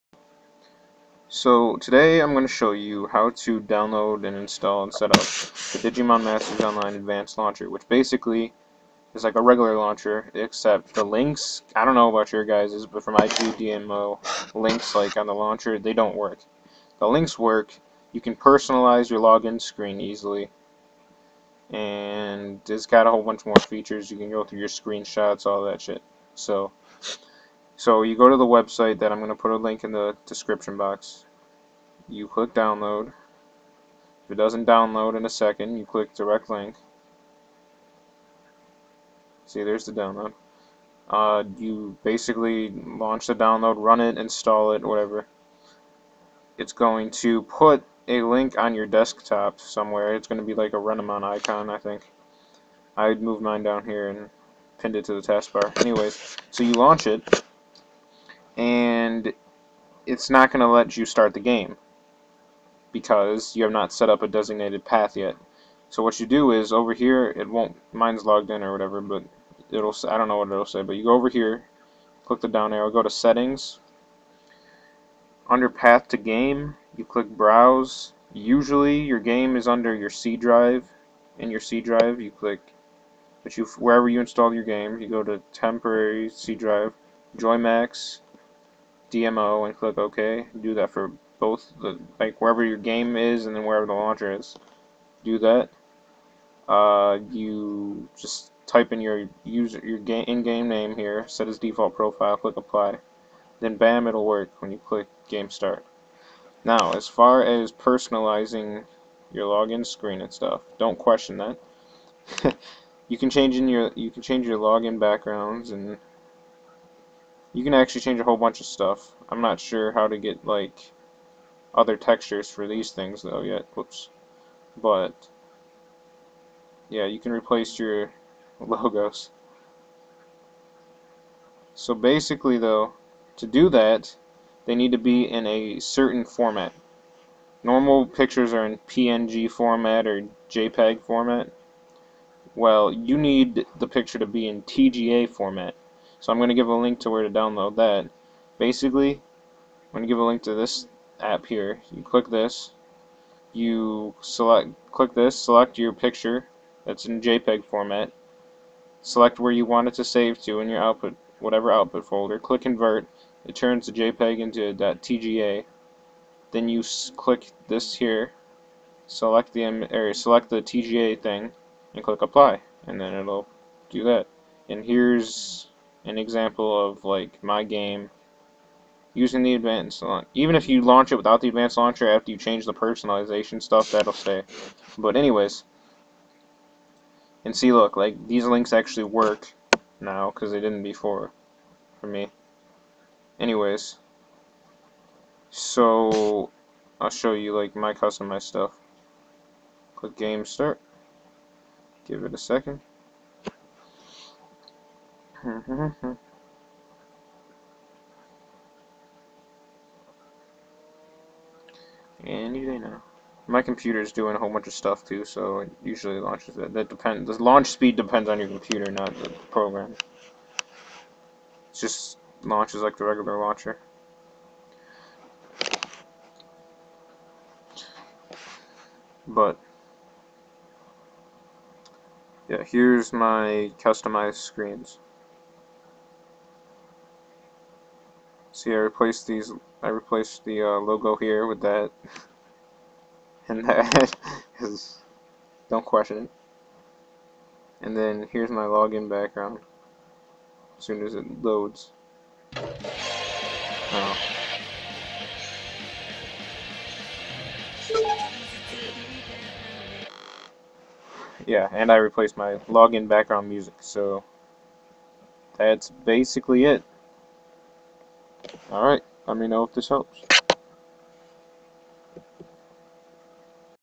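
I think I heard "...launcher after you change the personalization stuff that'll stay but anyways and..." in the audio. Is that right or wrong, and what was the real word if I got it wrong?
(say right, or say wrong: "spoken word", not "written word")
right.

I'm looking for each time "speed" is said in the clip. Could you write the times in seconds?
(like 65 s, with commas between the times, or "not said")
217 s.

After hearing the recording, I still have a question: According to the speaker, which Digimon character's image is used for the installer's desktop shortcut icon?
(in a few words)
Renamon.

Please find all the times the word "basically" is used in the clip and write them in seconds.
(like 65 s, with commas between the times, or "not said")
7 s, 42 s, 131 s, 148 s, 266 s.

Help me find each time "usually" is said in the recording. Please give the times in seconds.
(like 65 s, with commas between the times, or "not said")
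78 s, 215 s.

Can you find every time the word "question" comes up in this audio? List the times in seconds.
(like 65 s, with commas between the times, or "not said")
110 s, 245 s.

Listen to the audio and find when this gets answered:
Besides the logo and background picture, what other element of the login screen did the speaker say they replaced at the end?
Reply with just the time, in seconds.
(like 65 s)
262 s.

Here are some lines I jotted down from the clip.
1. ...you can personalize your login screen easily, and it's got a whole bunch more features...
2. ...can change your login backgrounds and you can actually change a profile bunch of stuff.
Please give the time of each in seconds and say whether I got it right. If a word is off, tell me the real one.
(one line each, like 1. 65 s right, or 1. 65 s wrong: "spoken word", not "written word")
1. 18 s right
2. 114 s wrong: "whole", not "profile".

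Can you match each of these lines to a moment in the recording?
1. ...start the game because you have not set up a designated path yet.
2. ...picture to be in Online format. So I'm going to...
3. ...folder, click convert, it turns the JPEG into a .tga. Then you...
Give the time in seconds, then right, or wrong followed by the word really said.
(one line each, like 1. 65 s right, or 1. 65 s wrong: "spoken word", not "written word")
1. 61 s right
2. 143 s wrong: "TGA", not "Online"
3. 162 s right.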